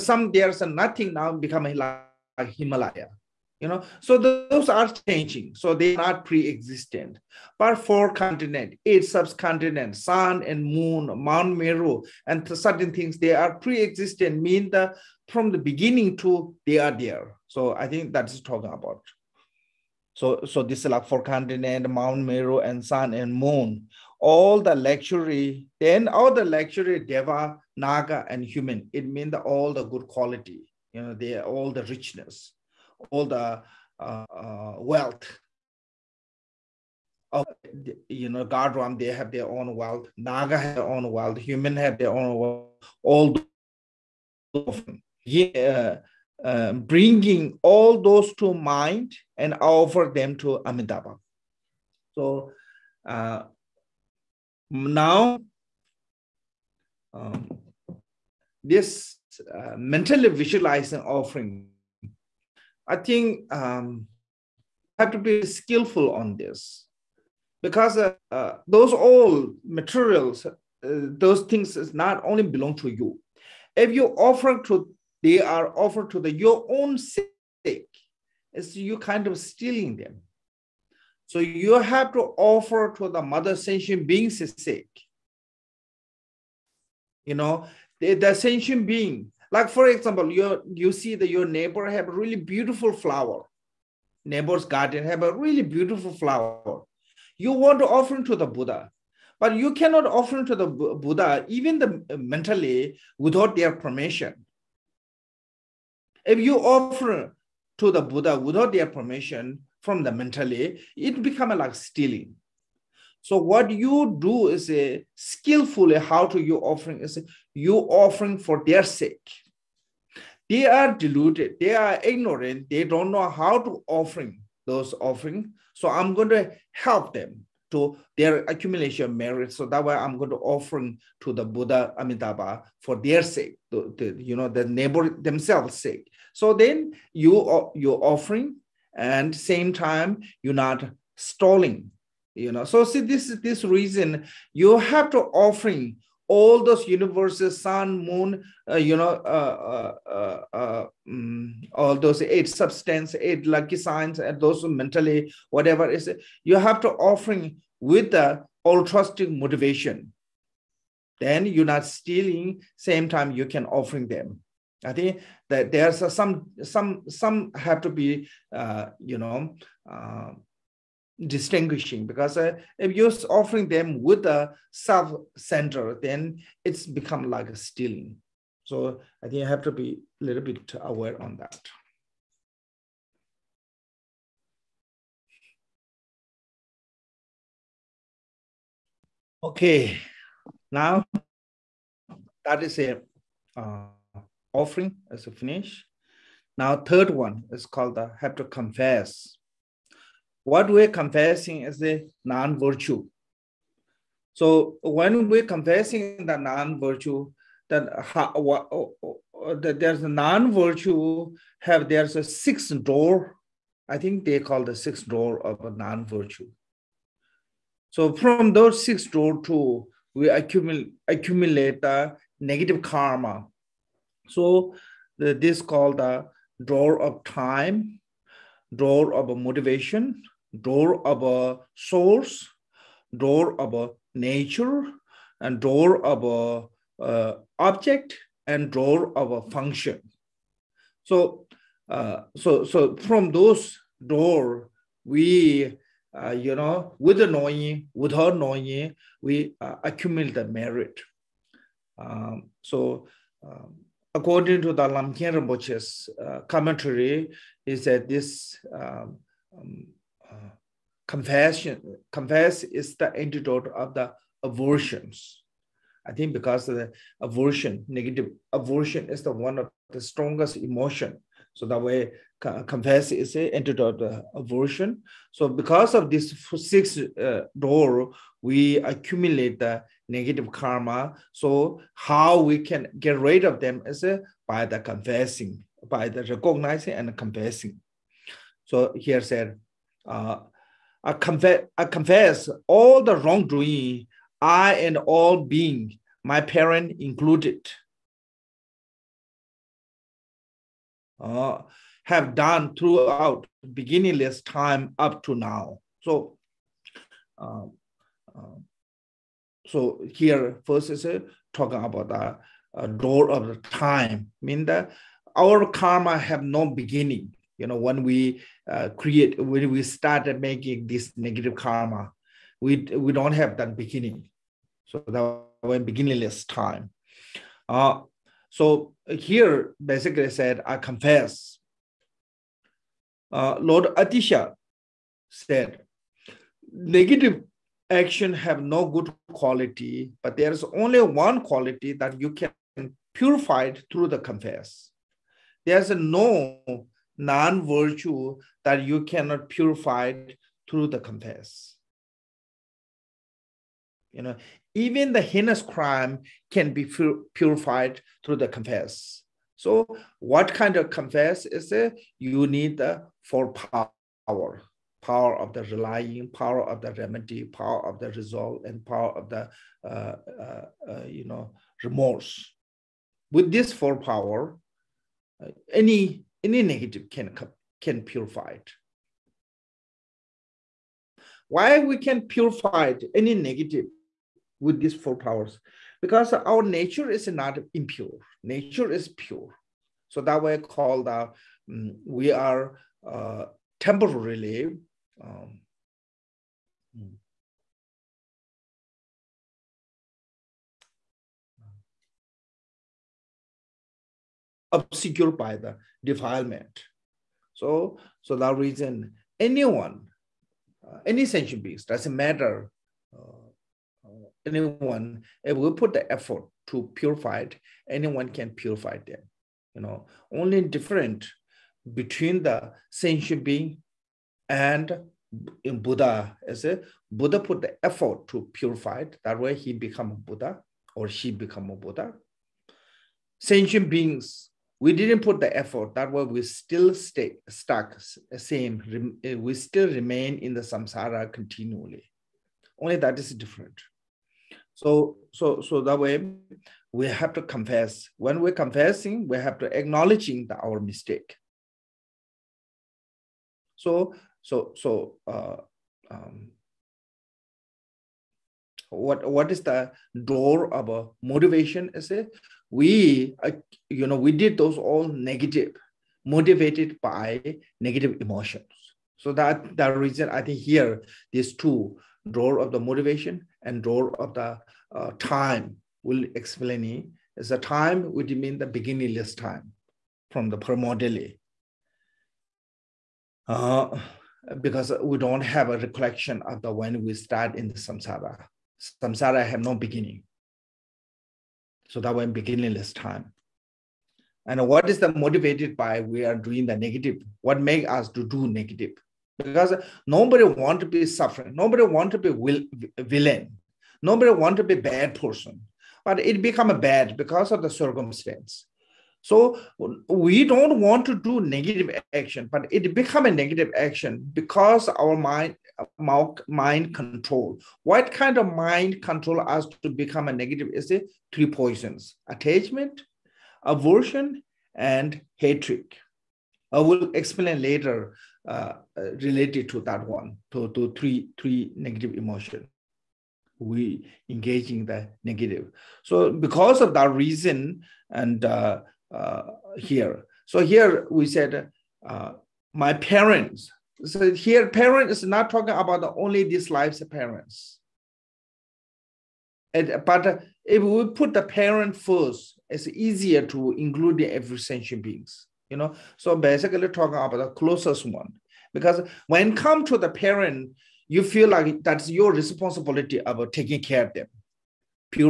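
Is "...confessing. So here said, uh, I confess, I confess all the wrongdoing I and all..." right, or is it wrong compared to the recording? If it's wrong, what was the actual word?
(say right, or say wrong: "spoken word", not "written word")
right.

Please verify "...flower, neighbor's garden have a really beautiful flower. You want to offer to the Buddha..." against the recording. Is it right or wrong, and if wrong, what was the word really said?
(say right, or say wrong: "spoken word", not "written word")
right.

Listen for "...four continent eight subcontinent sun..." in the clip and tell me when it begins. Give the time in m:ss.
0:07.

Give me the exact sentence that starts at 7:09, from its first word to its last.
That way, he become a Buddha or she become a Buddha.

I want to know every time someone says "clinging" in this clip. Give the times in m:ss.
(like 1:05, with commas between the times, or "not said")
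not said.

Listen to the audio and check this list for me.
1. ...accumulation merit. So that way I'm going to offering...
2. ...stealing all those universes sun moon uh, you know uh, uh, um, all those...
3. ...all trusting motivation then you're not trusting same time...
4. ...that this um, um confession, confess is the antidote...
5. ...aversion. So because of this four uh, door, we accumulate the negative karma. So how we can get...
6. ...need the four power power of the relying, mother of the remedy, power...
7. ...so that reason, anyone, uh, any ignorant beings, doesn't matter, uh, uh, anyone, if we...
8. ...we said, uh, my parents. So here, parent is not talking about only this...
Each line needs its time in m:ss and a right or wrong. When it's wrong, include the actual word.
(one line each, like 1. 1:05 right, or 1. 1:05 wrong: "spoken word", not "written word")
1. 2:08 right
2. 2:25 wrong: "offering", not "stealing"
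3. 2:38 wrong: "stealing", not "trusting"
4. 4:17 right
5. 4:34 wrong: "six", not "four"
6. 6:02 wrong: "power", not "mother"
7. 6:48 wrong: "sentient", not "ignorant"
8. 9:01 right.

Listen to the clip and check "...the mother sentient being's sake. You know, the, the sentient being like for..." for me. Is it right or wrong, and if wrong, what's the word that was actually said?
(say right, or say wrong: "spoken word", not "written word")
right.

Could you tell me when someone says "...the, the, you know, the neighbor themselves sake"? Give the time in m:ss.
2:13.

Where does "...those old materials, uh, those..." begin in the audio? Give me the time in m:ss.
1:08.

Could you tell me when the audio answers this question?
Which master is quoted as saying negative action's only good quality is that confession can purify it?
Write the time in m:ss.
5:33.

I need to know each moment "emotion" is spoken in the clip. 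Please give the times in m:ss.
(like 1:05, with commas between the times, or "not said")
4:30, 7:48, 8:52.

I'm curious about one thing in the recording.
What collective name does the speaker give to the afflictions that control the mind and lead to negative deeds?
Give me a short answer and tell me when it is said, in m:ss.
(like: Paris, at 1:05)
Three poisons, at 8:41.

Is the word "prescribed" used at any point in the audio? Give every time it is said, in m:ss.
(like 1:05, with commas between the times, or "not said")
not said.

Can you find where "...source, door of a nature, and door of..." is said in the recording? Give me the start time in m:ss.
3:51.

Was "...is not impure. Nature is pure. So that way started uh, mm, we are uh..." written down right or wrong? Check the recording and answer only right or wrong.
wrong.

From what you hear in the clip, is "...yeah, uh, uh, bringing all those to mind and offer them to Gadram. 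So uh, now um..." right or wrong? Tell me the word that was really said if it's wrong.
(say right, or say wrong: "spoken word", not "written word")
wrong: "Amitabha", not "Gadram".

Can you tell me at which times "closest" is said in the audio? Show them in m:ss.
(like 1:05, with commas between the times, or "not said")
9:17.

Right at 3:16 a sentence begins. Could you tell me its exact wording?
Now third one is called the have to confess.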